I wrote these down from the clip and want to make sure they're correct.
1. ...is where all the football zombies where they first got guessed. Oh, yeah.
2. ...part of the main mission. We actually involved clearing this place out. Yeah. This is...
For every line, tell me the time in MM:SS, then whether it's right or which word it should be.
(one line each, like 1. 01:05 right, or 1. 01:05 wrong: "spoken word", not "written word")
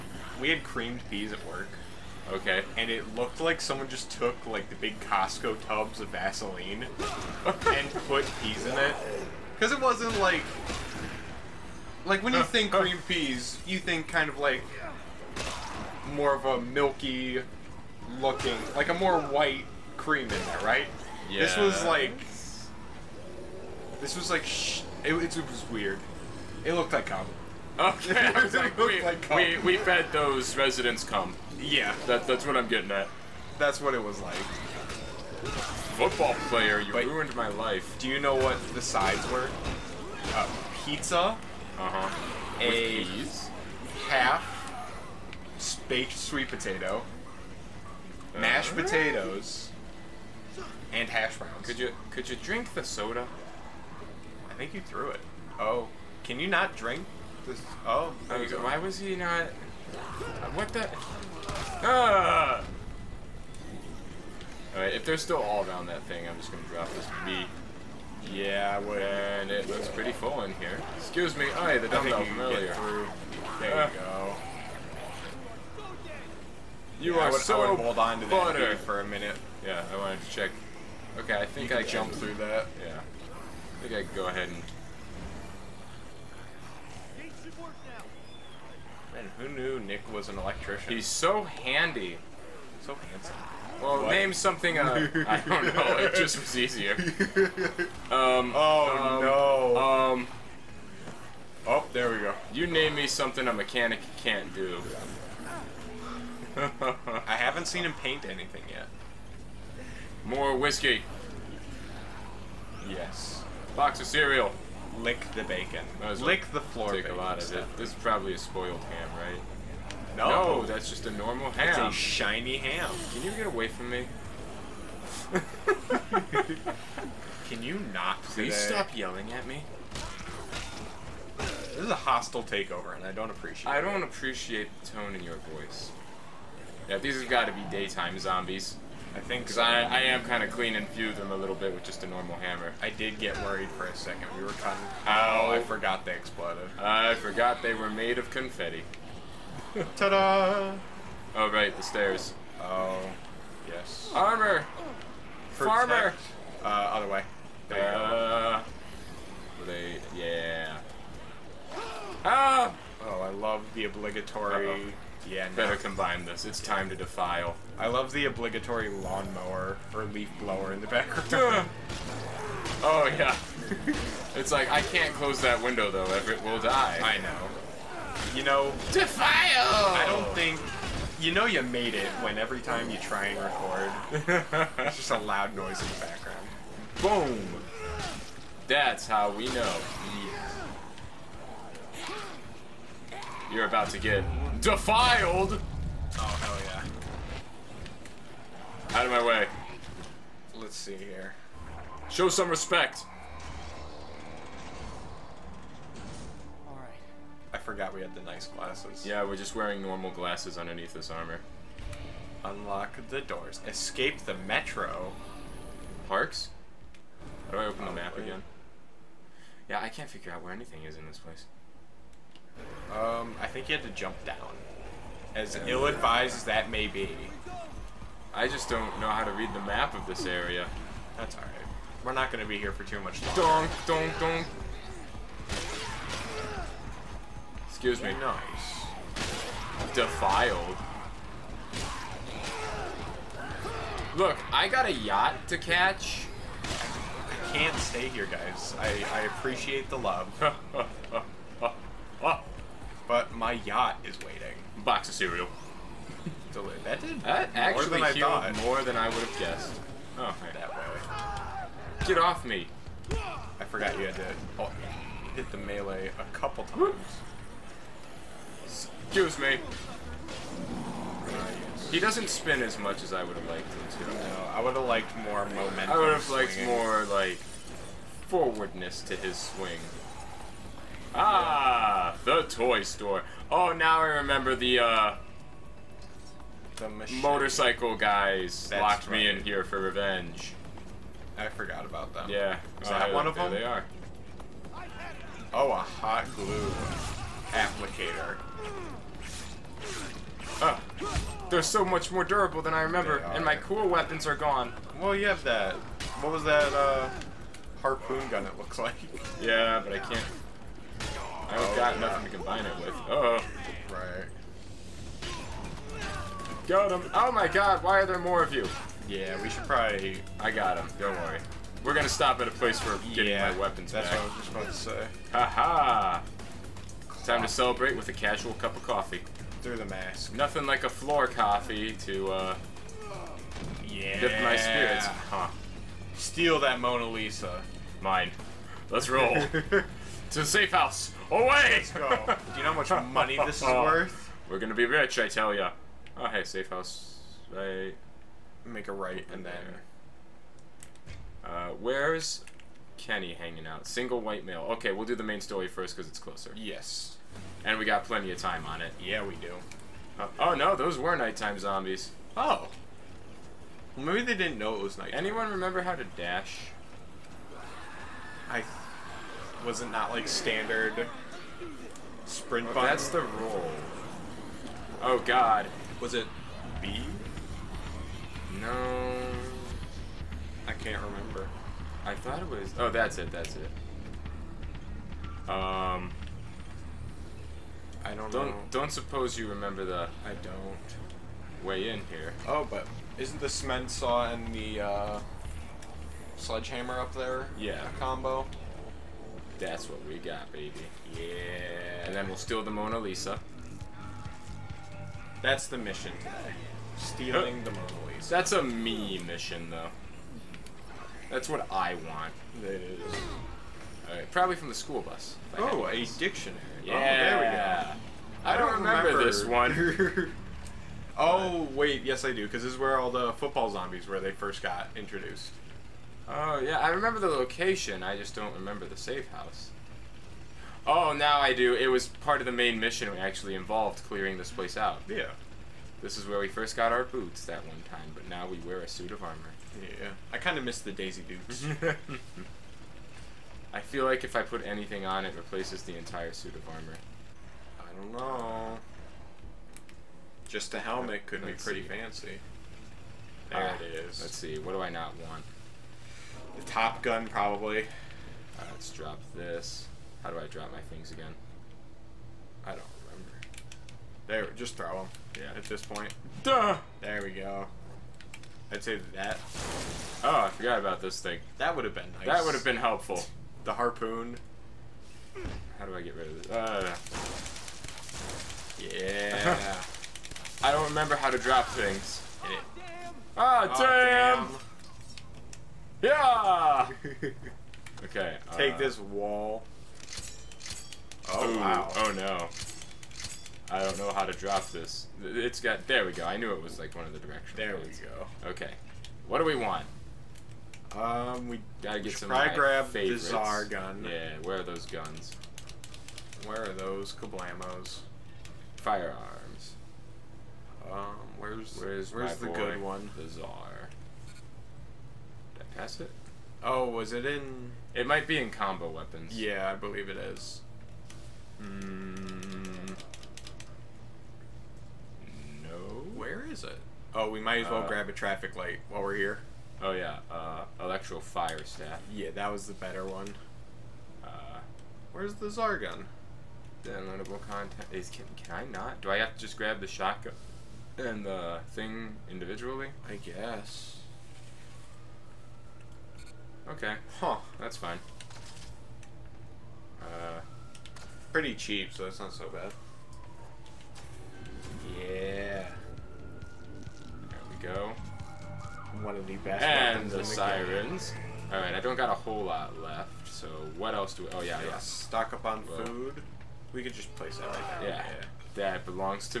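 1. 07:02 wrong: "introduced", not "guessed"
2. 07:12 right.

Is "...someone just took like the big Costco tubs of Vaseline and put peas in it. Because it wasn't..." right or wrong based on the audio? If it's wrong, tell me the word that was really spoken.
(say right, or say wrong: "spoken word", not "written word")
right.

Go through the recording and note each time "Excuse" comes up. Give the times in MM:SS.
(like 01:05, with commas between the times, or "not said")
01:10, 03:57, 04:29.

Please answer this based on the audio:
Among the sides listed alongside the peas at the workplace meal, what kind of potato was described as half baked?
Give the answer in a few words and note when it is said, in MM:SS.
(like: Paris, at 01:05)
Sweet potato, at 00:46.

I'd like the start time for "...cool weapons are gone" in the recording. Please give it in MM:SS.
05:03.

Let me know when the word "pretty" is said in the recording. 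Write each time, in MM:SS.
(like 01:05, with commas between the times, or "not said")
01:09, 07:31, 09:11.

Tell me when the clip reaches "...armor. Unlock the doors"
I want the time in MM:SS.
03:31.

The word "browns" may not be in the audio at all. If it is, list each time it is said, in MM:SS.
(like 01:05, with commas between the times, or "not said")
00:51.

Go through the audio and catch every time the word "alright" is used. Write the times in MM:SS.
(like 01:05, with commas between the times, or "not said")
01:04, 03:51.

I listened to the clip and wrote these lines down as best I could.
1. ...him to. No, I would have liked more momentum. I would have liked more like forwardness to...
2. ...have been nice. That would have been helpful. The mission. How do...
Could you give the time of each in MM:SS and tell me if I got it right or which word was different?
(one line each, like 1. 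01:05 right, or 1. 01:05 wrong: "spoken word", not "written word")
1. 04:33 right
2. 07:51 wrong: "harpoon", not "mission".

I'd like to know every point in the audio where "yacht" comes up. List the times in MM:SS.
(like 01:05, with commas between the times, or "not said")
04:04, 04:13.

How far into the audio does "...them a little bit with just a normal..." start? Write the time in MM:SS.
02:21.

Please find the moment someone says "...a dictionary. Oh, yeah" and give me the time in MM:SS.
06:55.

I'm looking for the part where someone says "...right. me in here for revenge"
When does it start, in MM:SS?
04:49.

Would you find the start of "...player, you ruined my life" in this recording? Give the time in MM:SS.
00:36.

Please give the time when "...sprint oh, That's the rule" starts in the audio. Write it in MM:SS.
06:12.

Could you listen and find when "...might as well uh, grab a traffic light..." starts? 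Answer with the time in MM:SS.
08:47.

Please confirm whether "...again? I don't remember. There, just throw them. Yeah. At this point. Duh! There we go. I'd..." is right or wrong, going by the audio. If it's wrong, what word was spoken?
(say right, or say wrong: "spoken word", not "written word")
right.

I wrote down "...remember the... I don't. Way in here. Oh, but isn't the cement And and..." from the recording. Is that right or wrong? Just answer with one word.
wrong.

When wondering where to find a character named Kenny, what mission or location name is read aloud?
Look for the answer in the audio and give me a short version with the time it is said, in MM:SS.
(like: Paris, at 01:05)
Single White Male, at 05:53.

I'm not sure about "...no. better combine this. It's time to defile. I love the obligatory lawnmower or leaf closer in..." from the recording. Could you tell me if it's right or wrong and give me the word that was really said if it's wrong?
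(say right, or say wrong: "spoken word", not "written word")
wrong: "blower", not "closer".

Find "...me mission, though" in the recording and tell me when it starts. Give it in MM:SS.
06:48.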